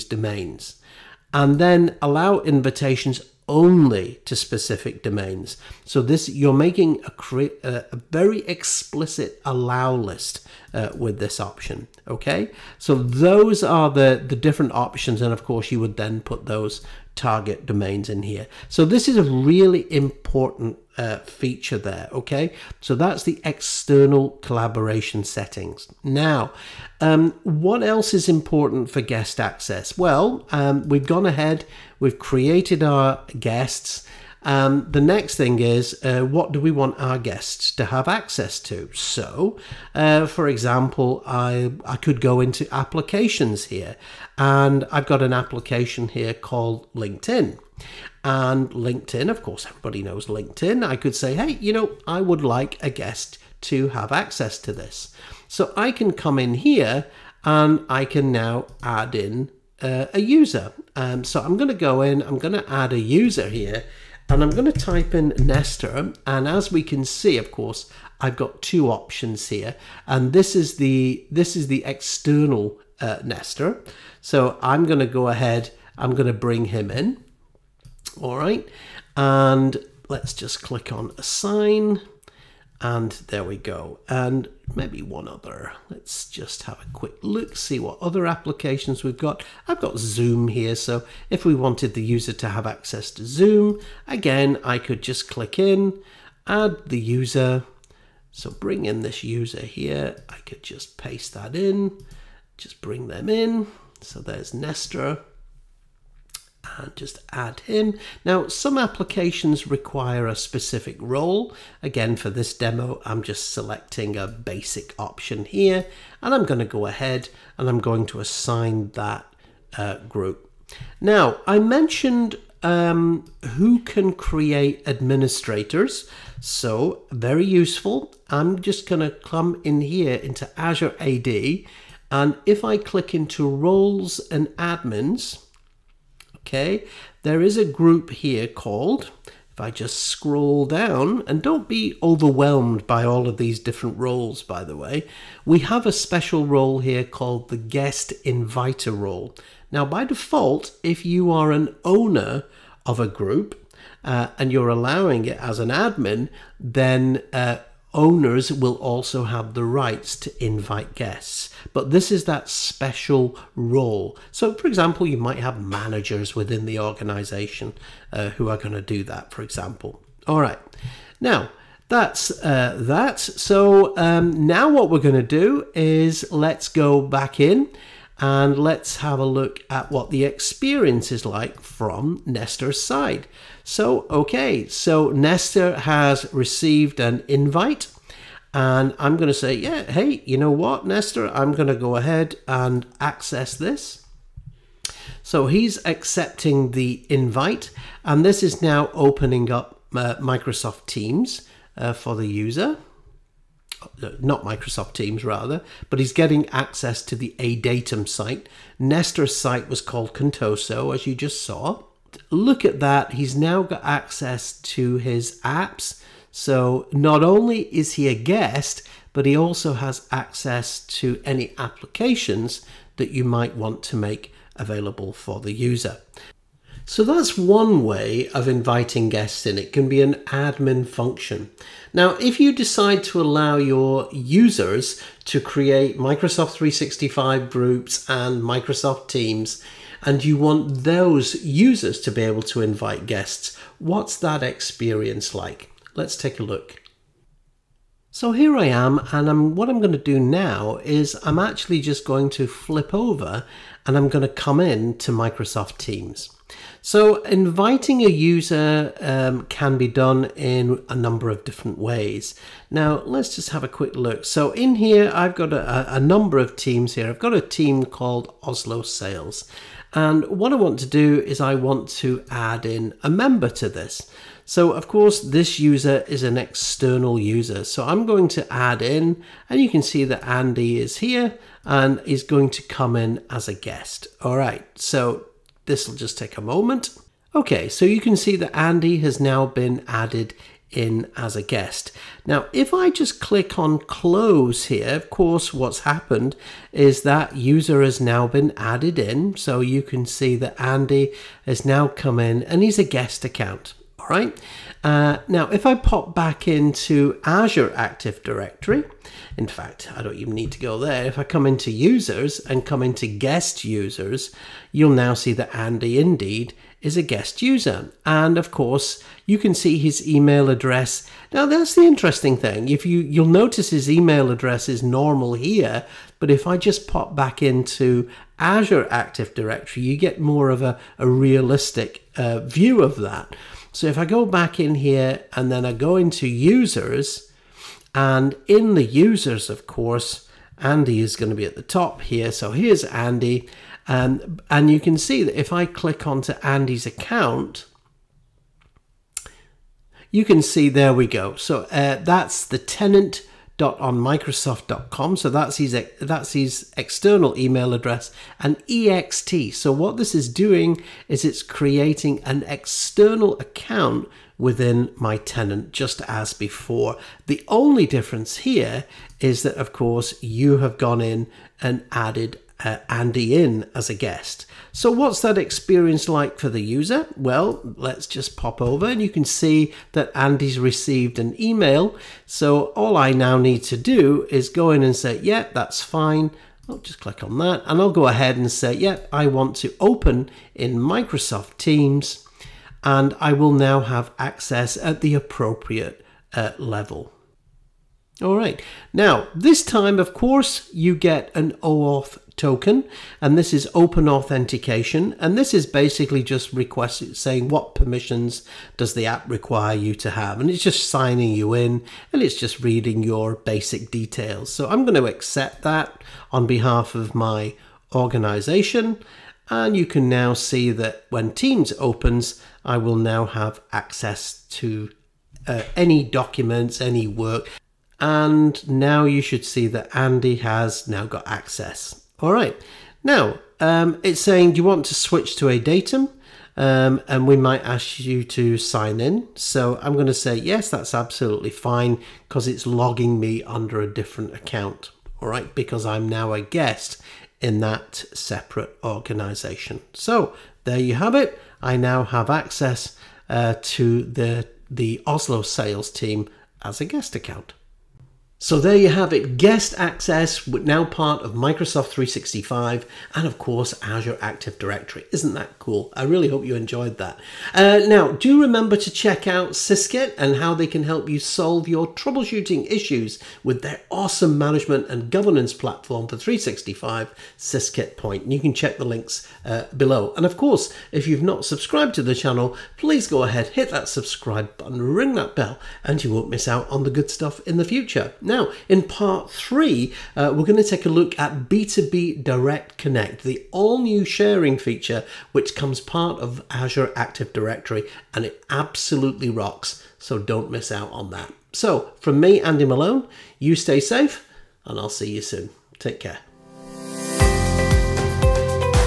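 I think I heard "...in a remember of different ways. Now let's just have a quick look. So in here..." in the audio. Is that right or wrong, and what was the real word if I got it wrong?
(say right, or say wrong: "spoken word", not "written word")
wrong: "number", not "remember".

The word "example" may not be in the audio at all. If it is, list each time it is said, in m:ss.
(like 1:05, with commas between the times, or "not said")
0:40, 2:44, 2:49.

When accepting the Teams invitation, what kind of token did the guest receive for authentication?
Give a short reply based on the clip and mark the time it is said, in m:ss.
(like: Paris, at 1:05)
OAuth token, at 6:41.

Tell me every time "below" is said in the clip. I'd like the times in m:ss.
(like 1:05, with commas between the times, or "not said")
7:59.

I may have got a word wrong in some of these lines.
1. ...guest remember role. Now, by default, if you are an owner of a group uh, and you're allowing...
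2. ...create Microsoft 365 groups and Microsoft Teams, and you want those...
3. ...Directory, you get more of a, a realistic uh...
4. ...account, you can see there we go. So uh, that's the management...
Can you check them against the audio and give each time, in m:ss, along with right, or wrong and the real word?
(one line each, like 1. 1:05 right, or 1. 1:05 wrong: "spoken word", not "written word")
1. 2:27 wrong: "inviter", not "remember"
2. 3:55 right
3. 5:29 right
4. 5:46 wrong: "tenant", not "management".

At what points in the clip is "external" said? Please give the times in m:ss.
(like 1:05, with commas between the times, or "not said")
0:23, 1:11, 4:36, 5:56, 6:02.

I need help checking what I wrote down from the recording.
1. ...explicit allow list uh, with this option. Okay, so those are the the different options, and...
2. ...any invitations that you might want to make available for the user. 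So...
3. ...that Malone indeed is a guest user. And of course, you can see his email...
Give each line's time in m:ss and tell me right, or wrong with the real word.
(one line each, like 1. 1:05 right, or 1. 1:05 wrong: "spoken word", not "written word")
1. 0:08 right
2. 3:41 wrong: "applications", not "invitations"
3. 5:15 wrong: "Andy", not "Malone".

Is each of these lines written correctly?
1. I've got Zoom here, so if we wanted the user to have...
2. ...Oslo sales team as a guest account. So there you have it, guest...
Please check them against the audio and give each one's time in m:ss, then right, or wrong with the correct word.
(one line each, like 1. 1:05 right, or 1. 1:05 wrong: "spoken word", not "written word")
1. 1:29 right
2. 7:35 right.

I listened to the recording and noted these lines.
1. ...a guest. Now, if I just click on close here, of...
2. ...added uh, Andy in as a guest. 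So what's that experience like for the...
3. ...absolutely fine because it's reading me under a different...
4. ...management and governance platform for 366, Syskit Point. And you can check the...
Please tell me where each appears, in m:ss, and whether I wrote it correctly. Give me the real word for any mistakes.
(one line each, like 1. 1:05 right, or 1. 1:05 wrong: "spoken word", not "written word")
1. 4:51 right
2. 6:11 right
3. 7:20 wrong: "logging", not "reading"
4. 7:54 wrong: "365", not "366".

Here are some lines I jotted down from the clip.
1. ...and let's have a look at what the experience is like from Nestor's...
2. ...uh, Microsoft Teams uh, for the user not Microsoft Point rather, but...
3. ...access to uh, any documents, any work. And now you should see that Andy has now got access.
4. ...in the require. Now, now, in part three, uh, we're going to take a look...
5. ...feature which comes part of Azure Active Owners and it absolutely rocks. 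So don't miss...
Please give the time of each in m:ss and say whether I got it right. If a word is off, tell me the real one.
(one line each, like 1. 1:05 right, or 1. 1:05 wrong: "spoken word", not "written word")
1. 2:58 right
2. 3:19 wrong: "Teams", not "Point"
3. 7:03 right
4. 8:07 wrong: "future", not "require"
5. 8:14 wrong: "Directory", not "Owners".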